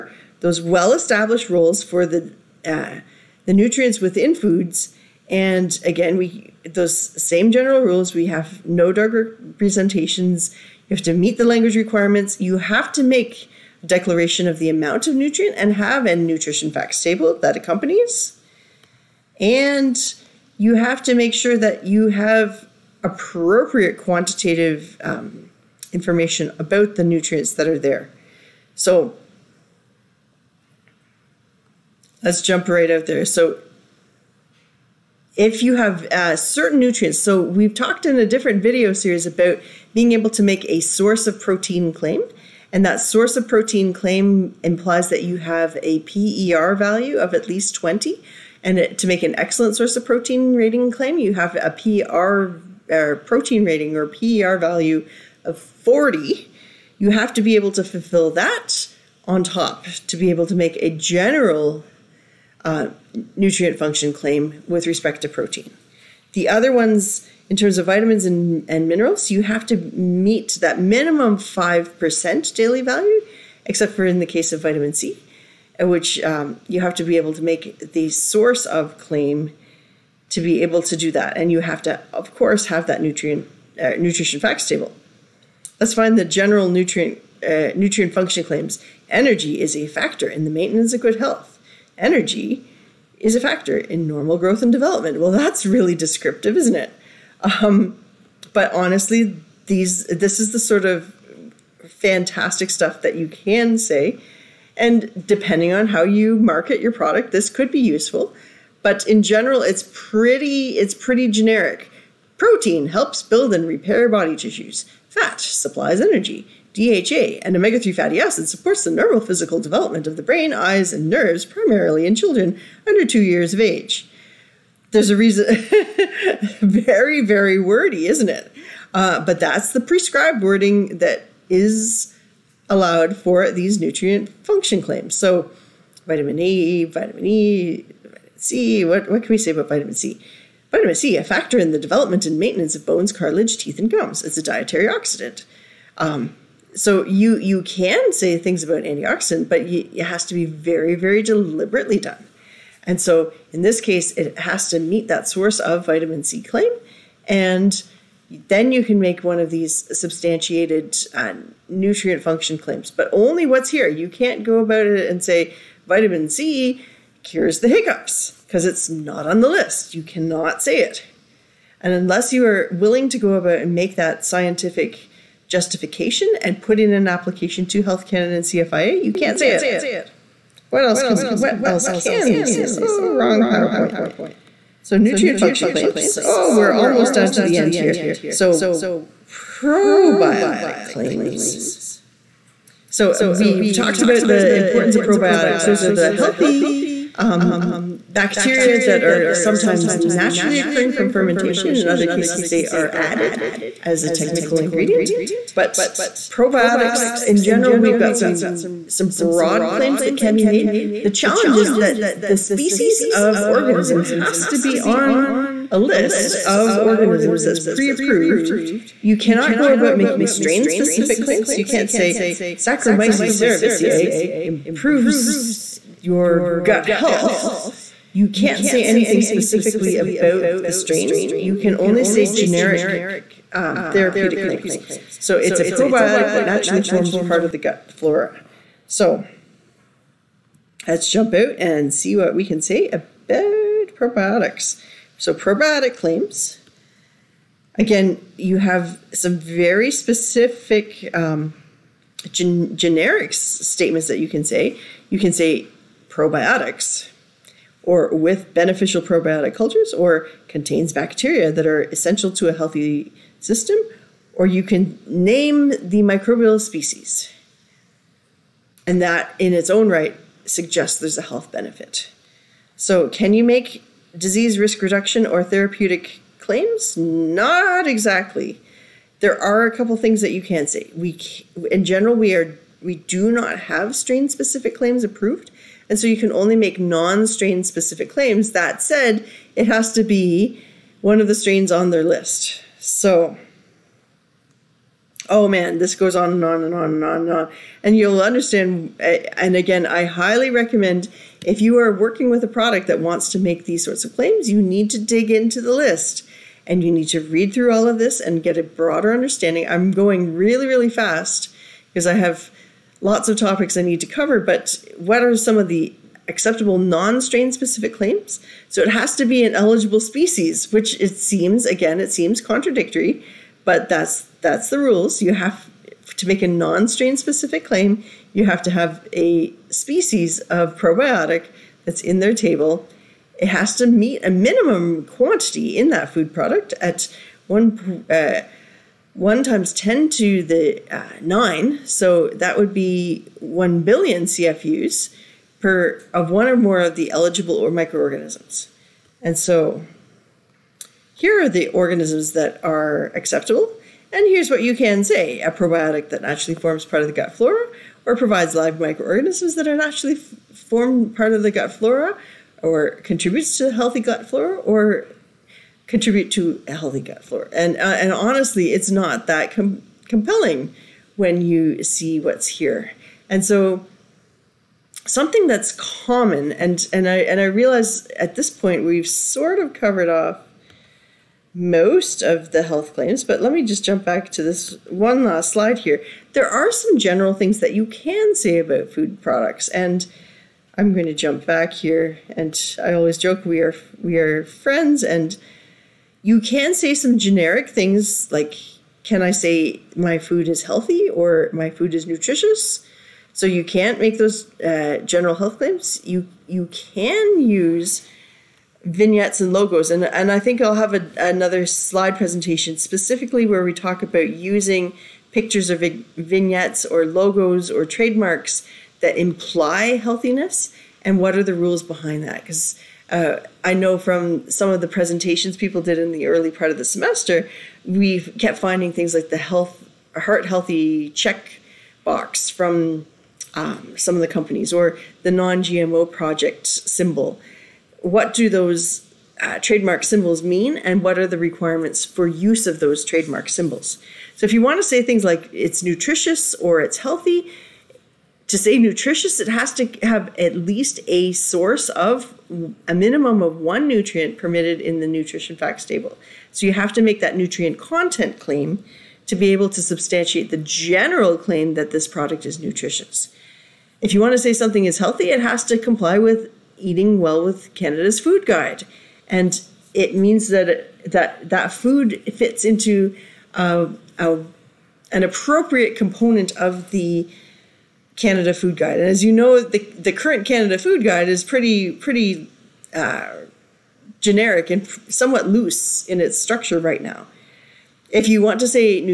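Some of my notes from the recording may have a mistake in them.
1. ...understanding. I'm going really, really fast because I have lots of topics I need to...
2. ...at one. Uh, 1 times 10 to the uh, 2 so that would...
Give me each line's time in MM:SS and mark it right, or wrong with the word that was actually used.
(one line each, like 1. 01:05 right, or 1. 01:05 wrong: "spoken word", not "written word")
1. 05:09 right
2. 05:36 wrong: "9", not "2".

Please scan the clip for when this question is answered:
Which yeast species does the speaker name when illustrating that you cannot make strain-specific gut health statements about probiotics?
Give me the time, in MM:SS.
03:42.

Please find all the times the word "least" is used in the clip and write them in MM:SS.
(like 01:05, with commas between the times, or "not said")
00:47, 07:30.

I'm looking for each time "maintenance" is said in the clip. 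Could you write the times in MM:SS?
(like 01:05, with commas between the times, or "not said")
01:30, 02:22.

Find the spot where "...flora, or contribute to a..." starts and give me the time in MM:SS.
06:04.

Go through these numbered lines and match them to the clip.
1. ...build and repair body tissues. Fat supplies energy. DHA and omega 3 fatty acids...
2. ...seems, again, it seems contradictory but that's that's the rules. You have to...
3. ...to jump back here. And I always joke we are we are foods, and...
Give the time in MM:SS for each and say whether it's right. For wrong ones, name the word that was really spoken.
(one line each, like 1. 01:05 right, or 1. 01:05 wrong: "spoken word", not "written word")
1. 01:53 right
2. 05:21 right
3. 06:31 wrong: "friends", not "foods".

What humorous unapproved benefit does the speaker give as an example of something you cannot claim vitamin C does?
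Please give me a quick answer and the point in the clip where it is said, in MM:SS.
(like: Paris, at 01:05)
cures the hiccups, at 02:47.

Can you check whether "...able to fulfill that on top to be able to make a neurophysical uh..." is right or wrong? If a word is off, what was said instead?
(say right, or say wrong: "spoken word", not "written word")
wrong: "general", not "neurophysical".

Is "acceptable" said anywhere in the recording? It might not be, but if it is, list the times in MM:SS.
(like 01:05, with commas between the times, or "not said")
05:16, 05:53.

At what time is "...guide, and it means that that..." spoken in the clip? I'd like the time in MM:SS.
07:48.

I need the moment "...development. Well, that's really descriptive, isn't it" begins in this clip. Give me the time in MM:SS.
01:34.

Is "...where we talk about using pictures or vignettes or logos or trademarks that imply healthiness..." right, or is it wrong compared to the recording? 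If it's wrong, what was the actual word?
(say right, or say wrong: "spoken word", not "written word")
right.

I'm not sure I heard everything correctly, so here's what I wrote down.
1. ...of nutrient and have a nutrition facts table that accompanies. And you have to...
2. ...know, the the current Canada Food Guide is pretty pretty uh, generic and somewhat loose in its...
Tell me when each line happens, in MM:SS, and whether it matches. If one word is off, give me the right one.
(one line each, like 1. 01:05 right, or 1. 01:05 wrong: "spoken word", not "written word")
1. 00:15 right
2. 07:59 right.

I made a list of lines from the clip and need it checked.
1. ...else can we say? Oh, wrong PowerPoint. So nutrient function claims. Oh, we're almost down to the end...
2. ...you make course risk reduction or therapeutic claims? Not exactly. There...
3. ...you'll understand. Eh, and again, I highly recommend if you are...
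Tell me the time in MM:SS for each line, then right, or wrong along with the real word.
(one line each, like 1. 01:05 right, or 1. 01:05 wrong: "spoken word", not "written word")
1. 03:01 right
2. 04:33 wrong: "disease", not "course"
3. 04:57 right.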